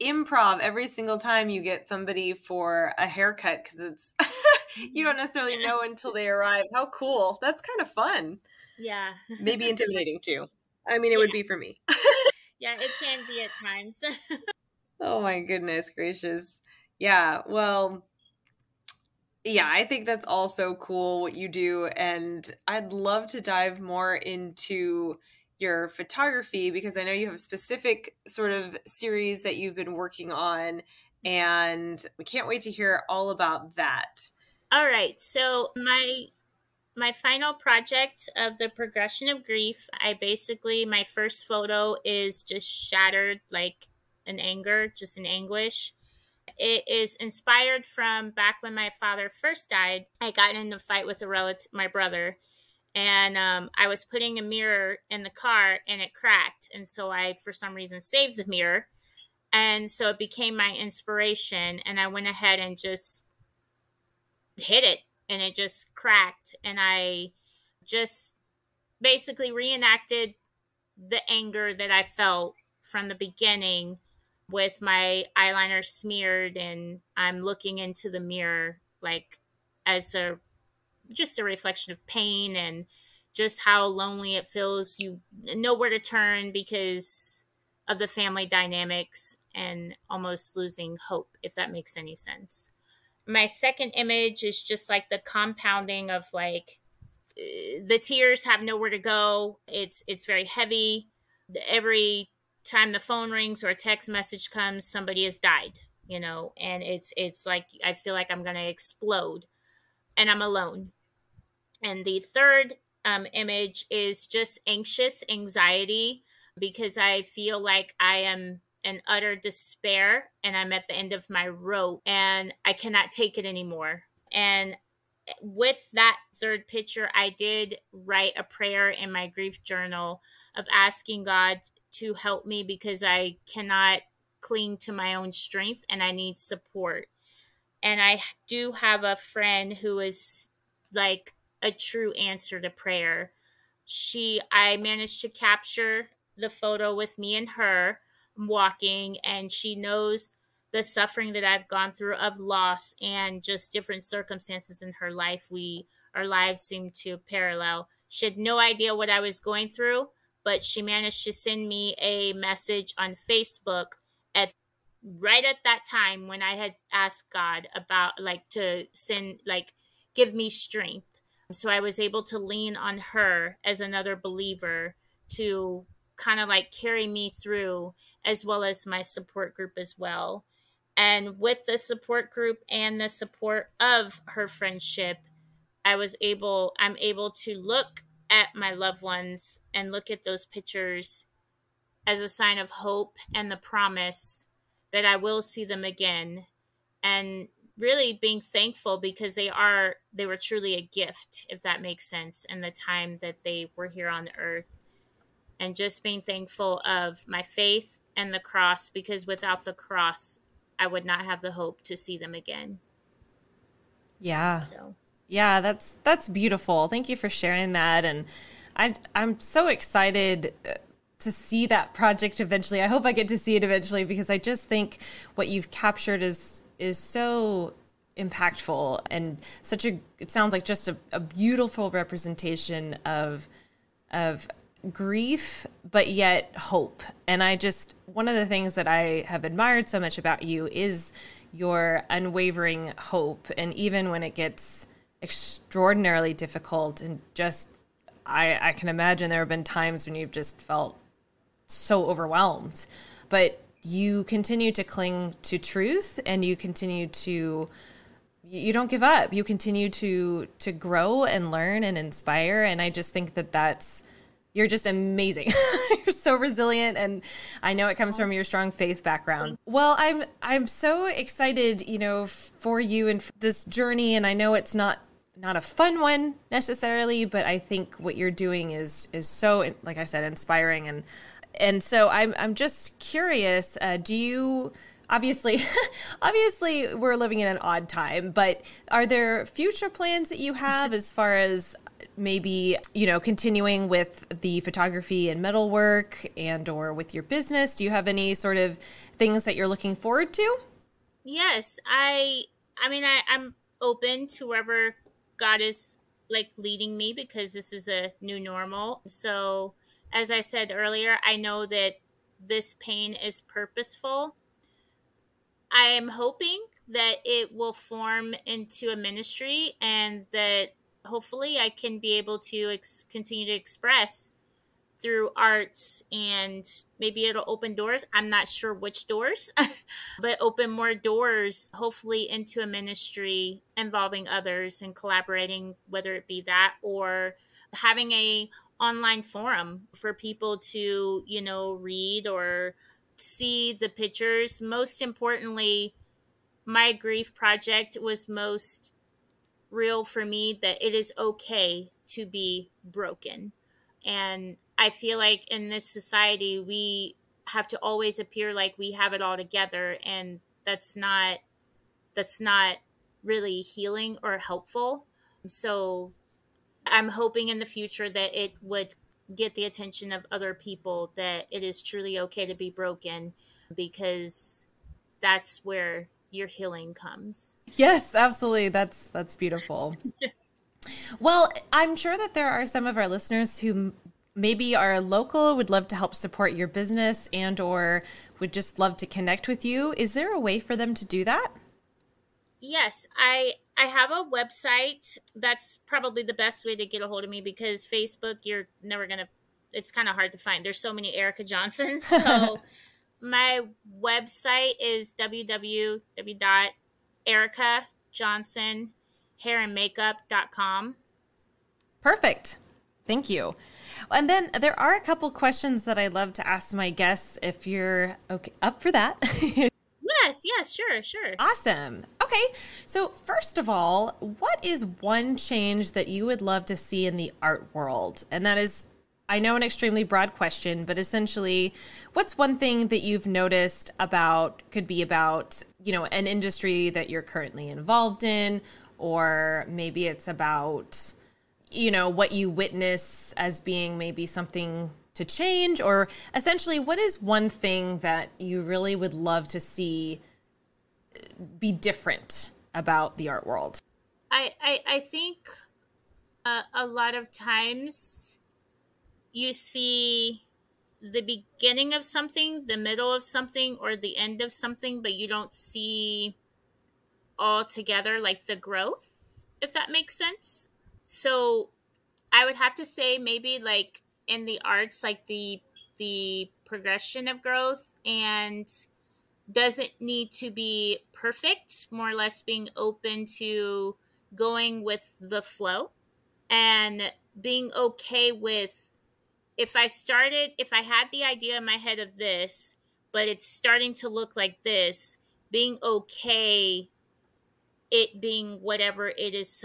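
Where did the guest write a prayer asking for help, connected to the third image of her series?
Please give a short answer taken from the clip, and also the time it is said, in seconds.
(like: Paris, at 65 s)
Grief journal, at 129 s.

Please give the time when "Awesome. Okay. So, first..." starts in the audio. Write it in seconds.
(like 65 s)
421 s.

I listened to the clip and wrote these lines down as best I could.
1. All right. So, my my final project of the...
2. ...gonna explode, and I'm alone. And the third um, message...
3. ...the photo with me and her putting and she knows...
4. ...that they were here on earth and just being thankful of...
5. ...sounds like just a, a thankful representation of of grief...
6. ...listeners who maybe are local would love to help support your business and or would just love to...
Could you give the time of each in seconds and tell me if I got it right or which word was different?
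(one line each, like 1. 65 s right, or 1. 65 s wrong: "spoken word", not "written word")
1. 34 s right
2. 108 s wrong: "image", not "message"
3. 146 s wrong: "walking", not "putting"
4. 203 s right
5. 230 s wrong: "beautiful", not "thankful"
6. 383 s right.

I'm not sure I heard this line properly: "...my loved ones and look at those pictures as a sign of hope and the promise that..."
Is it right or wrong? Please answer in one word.
right.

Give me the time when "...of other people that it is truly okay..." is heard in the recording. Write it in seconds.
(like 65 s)
370 s.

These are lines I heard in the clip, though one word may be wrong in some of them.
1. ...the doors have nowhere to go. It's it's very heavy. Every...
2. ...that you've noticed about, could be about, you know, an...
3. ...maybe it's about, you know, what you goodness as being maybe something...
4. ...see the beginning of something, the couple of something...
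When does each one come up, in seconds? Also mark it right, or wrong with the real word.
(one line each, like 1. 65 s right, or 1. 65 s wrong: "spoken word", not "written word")
1. 97 s wrong: "tears", not "doors"
2. 432 s right
3. 439 s wrong: "witness", not "goodness"
4. 459 s wrong: "middle", not "couple".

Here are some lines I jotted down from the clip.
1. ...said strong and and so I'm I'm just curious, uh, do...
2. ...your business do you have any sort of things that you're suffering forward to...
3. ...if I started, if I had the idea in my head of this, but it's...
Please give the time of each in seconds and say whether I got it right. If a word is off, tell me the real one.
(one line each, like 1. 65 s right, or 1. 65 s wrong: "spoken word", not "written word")
1. 280 s wrong: "inspiring", not "strong"
2. 297 s wrong: "looking", not "suffering"
3. 489 s right.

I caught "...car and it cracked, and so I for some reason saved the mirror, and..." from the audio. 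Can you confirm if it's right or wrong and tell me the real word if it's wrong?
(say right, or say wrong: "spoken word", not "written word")
right.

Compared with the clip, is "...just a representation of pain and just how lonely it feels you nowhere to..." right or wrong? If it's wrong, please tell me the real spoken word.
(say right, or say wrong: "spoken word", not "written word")
wrong: "reflection", not "representation".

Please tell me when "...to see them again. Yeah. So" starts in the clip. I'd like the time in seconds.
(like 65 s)
211 s.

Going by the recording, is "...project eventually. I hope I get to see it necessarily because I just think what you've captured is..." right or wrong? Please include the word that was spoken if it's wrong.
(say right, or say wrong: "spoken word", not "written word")
wrong: "eventually", not "necessarily".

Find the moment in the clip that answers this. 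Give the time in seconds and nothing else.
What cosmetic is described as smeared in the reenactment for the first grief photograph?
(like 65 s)
75 s.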